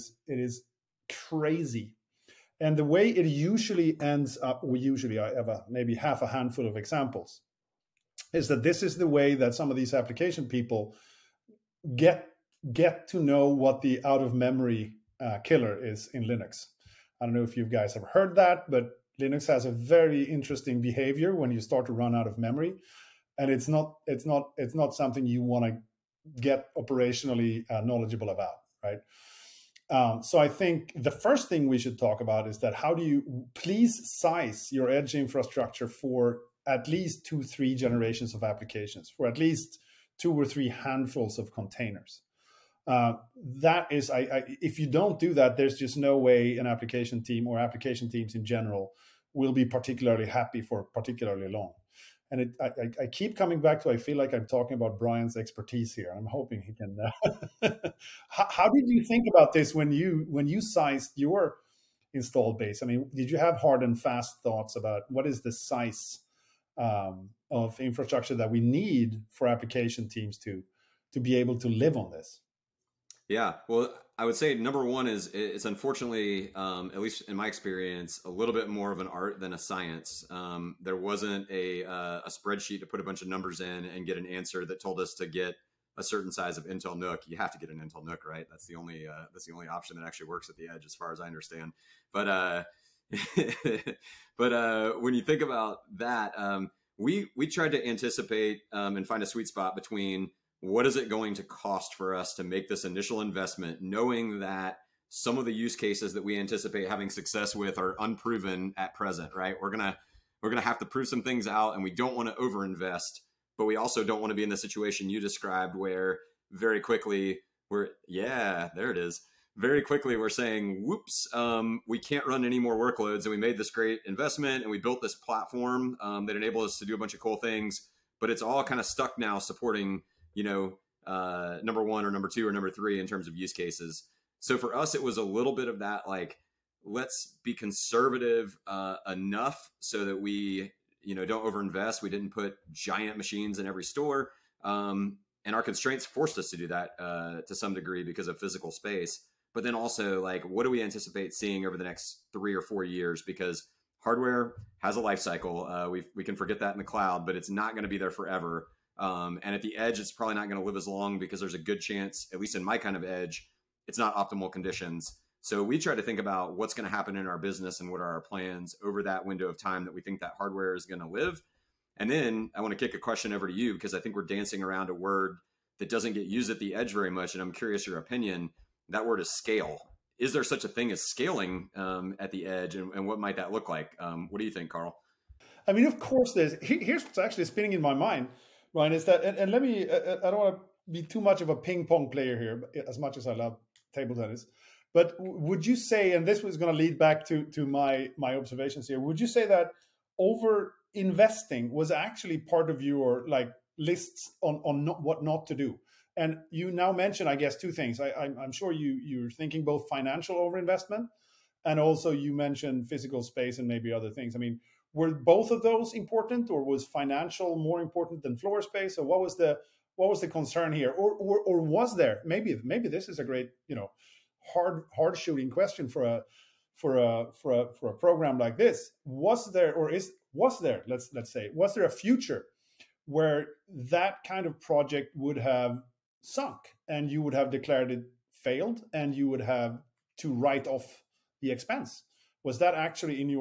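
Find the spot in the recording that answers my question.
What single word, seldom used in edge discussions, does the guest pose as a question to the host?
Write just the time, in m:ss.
2:59.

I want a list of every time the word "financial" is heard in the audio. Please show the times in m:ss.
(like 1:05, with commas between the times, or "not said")
3:29, 3:36.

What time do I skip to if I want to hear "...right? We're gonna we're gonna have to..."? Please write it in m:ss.
1:49.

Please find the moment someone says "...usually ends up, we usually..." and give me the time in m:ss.
0:03.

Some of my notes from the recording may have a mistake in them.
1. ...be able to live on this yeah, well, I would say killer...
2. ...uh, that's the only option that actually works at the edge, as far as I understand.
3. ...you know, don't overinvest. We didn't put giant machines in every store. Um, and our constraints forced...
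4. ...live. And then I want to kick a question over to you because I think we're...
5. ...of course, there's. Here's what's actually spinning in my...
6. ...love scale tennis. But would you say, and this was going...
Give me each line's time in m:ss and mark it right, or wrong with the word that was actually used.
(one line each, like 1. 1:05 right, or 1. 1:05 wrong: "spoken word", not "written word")
1. 1:11 wrong: "number", not "killer"
2. 1:29 right
3. 2:21 right
4. 2:51 right
5. 3:05 right
6. 3:13 wrong: "table", not "scale".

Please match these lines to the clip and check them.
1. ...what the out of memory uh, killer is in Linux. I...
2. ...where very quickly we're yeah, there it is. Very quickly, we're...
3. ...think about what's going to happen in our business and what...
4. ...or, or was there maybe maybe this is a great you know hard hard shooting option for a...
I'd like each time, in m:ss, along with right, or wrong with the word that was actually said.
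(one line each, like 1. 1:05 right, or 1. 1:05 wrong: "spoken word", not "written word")
1. 0:13 right
2. 1:55 right
3. 2:46 right
4. 3:41 wrong: "question", not "option".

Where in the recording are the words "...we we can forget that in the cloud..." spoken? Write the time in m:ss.
2:35.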